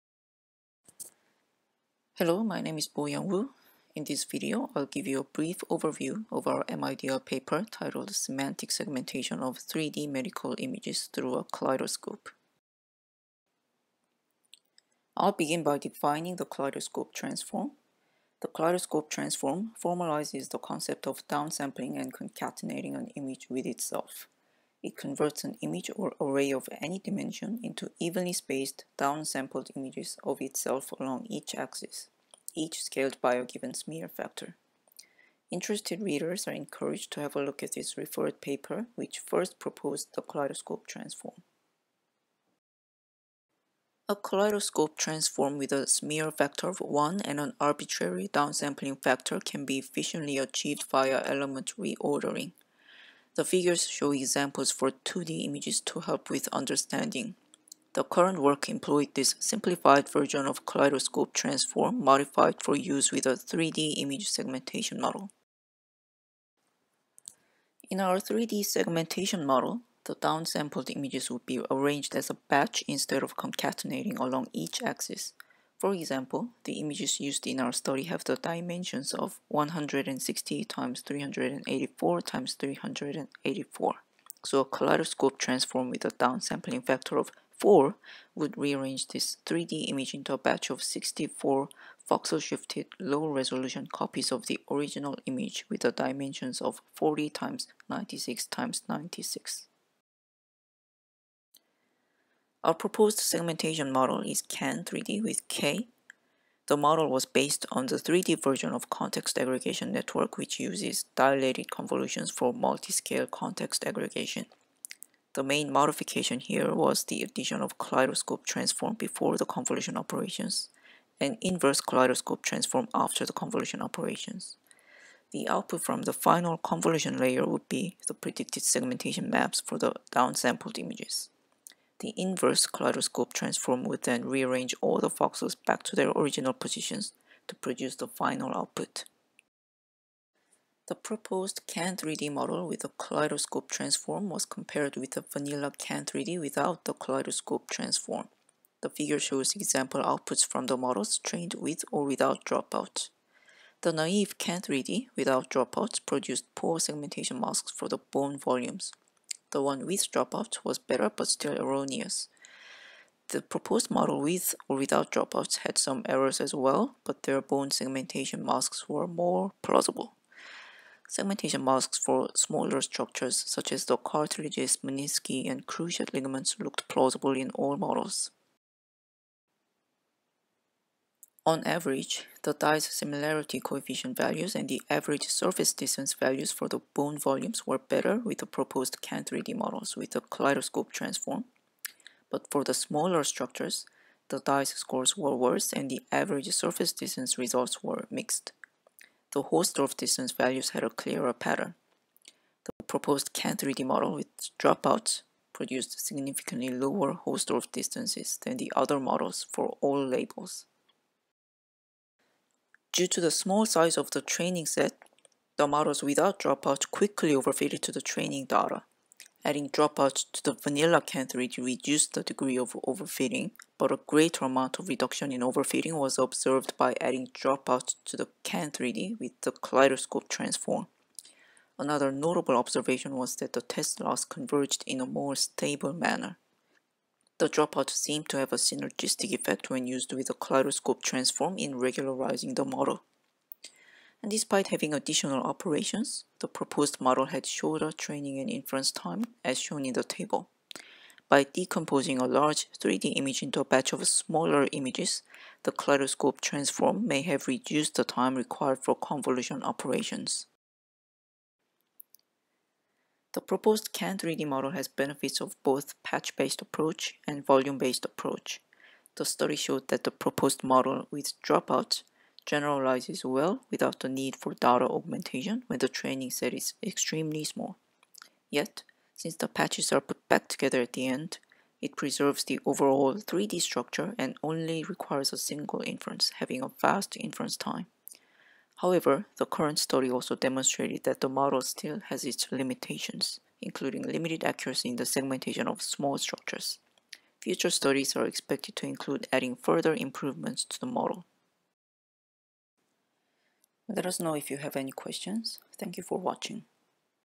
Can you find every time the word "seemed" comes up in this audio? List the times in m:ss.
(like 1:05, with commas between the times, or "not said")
3:57.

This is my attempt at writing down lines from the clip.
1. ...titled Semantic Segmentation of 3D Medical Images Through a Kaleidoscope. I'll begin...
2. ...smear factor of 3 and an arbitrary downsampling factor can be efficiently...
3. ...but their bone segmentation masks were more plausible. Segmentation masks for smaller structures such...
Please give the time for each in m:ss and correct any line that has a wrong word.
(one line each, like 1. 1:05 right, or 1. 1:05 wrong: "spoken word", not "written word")
1. 0:07 right
2. 0:45 wrong: "1", not "3"
3. 2:47 right.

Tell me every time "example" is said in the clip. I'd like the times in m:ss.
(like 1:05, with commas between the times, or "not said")
0:54, 1:15, 2:29.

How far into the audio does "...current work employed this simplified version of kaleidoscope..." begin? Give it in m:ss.
0:58.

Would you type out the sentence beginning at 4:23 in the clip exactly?
The proposed CAN3D model has benefits of both patch-based approach and volume-based approach.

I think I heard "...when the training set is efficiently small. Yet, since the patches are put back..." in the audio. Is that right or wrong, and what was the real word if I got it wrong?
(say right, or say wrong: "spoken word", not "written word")
wrong: "extremely", not "efficiently".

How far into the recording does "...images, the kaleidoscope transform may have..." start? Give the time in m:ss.
4:14.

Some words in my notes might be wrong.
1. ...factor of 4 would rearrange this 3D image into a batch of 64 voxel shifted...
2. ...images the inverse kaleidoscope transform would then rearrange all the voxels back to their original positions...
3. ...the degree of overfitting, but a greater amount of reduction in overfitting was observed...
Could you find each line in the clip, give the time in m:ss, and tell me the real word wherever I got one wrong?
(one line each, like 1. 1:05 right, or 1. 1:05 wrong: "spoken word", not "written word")
1. 1:26 right
2. 2:10 right
3. 3:42 right.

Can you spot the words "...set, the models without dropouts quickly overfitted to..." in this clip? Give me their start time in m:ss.
3:34.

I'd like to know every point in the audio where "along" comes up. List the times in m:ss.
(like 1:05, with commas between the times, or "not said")
0:30, 1:14.